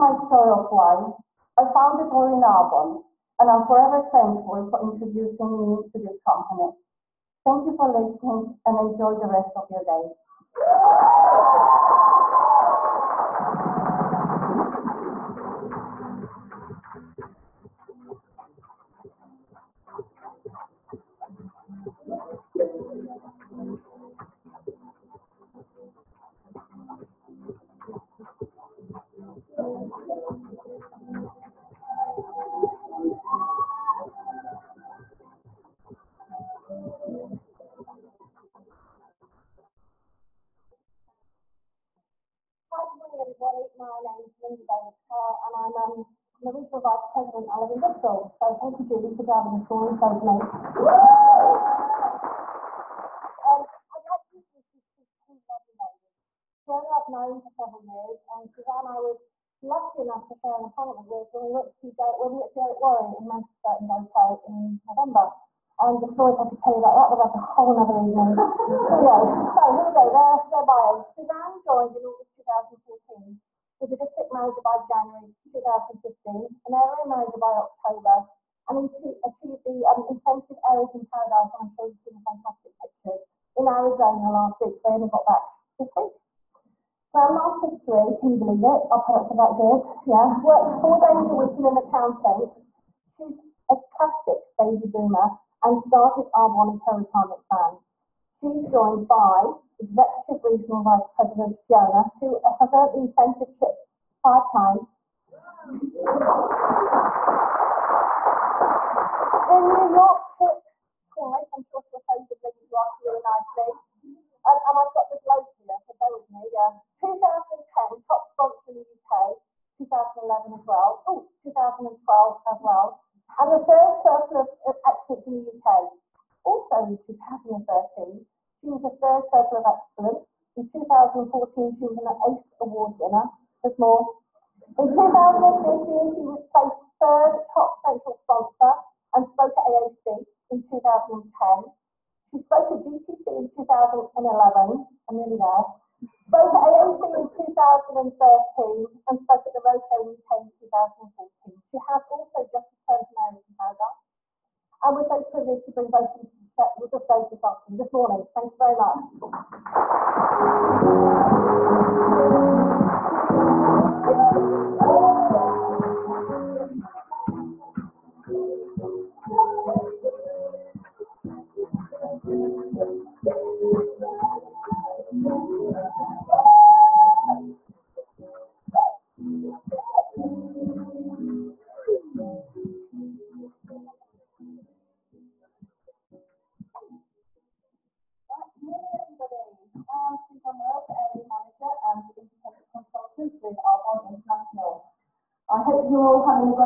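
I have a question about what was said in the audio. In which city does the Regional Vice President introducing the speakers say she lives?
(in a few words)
Bristol.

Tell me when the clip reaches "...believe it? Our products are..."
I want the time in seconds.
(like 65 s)
88 s.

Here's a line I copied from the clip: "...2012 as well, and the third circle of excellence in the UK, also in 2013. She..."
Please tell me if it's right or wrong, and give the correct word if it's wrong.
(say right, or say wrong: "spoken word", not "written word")
right.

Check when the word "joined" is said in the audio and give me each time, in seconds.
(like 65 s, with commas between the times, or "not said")
71 s, 98 s.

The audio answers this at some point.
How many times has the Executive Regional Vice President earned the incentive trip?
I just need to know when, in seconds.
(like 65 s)
104 s.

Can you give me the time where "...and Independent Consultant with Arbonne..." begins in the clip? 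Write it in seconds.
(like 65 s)
191 s.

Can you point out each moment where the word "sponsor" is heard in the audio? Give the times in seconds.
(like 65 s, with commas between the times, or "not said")
118 s, 138 s.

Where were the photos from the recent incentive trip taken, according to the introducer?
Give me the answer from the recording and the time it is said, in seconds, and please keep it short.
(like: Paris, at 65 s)
Arizona, at 83 s.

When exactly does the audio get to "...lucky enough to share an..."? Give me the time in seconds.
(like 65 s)
59 s.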